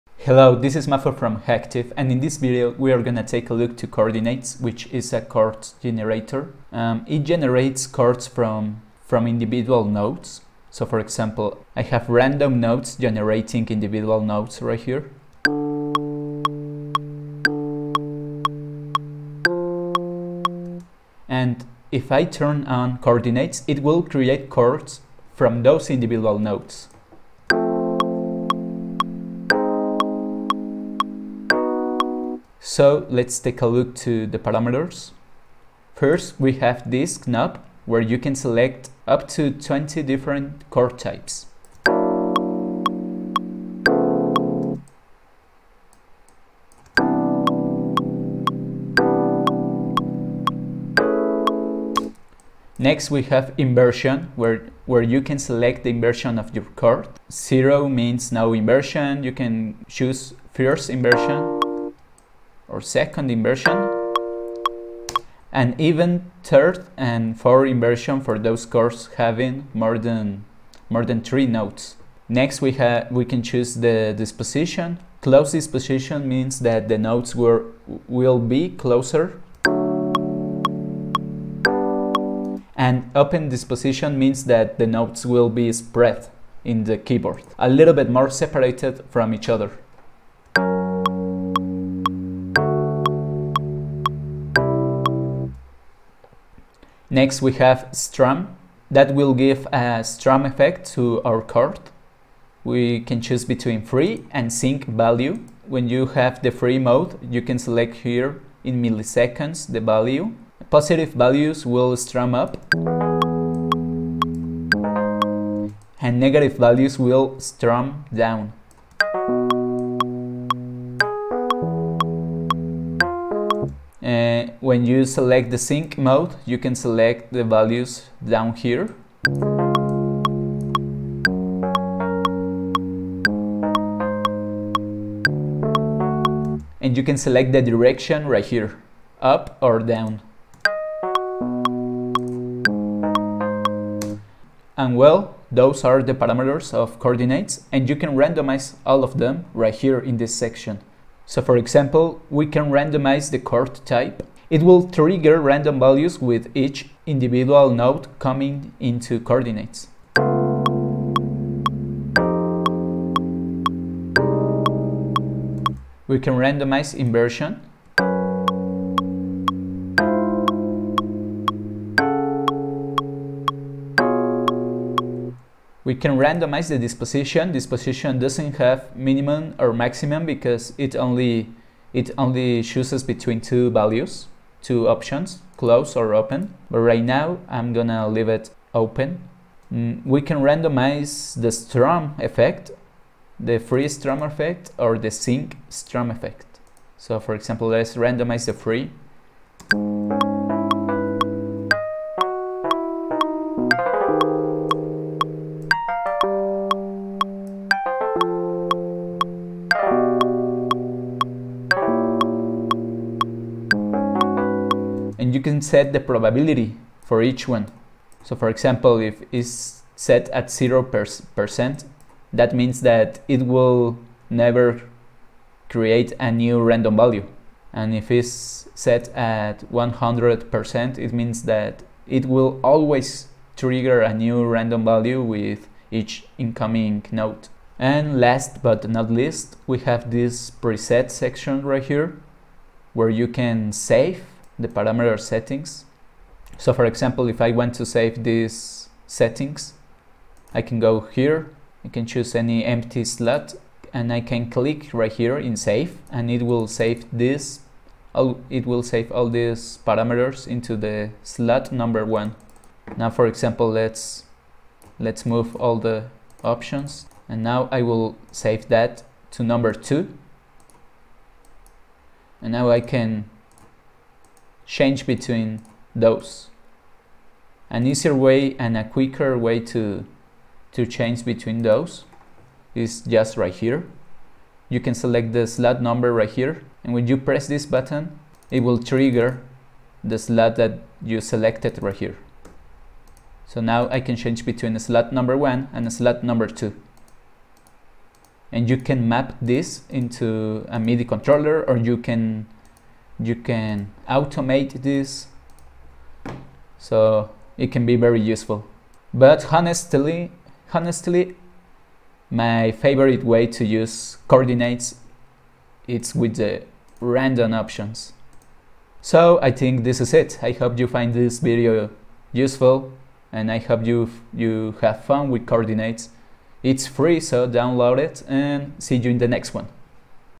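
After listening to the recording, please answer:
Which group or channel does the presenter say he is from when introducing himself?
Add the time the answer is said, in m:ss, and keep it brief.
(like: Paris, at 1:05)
Hacktive, at 0:01.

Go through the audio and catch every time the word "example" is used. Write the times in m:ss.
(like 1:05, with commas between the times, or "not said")
0:10, 2:31, 3:17, 3:38, 4:06, 4:23.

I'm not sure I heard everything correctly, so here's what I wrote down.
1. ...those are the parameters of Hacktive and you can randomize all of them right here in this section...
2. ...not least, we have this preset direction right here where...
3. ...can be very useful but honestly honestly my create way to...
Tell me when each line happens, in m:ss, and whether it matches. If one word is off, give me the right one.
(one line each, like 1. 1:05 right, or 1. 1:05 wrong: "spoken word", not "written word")
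1. 2:25 wrong: "CHORDinates", not "Hacktive"
2. 3:58 wrong: "section", not "direction"
3. 5:07 wrong: "favorite", not "create".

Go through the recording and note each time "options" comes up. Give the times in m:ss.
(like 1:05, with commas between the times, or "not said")
3:04, 4:26, 5:17.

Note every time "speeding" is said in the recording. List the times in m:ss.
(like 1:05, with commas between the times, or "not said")
not said.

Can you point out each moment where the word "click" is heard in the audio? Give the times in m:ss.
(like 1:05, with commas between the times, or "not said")
4:14.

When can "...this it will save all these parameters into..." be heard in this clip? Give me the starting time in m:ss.
4:17.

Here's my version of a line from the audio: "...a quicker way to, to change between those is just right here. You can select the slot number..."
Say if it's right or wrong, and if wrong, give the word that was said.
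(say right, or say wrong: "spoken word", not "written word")
right.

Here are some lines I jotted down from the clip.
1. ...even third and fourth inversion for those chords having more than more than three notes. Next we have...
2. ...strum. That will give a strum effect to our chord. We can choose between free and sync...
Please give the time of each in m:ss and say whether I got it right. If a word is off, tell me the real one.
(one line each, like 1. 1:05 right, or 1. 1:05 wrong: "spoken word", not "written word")
1. 1:05 right
2. 1:37 right.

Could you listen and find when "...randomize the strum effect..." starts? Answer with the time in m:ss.
3:10.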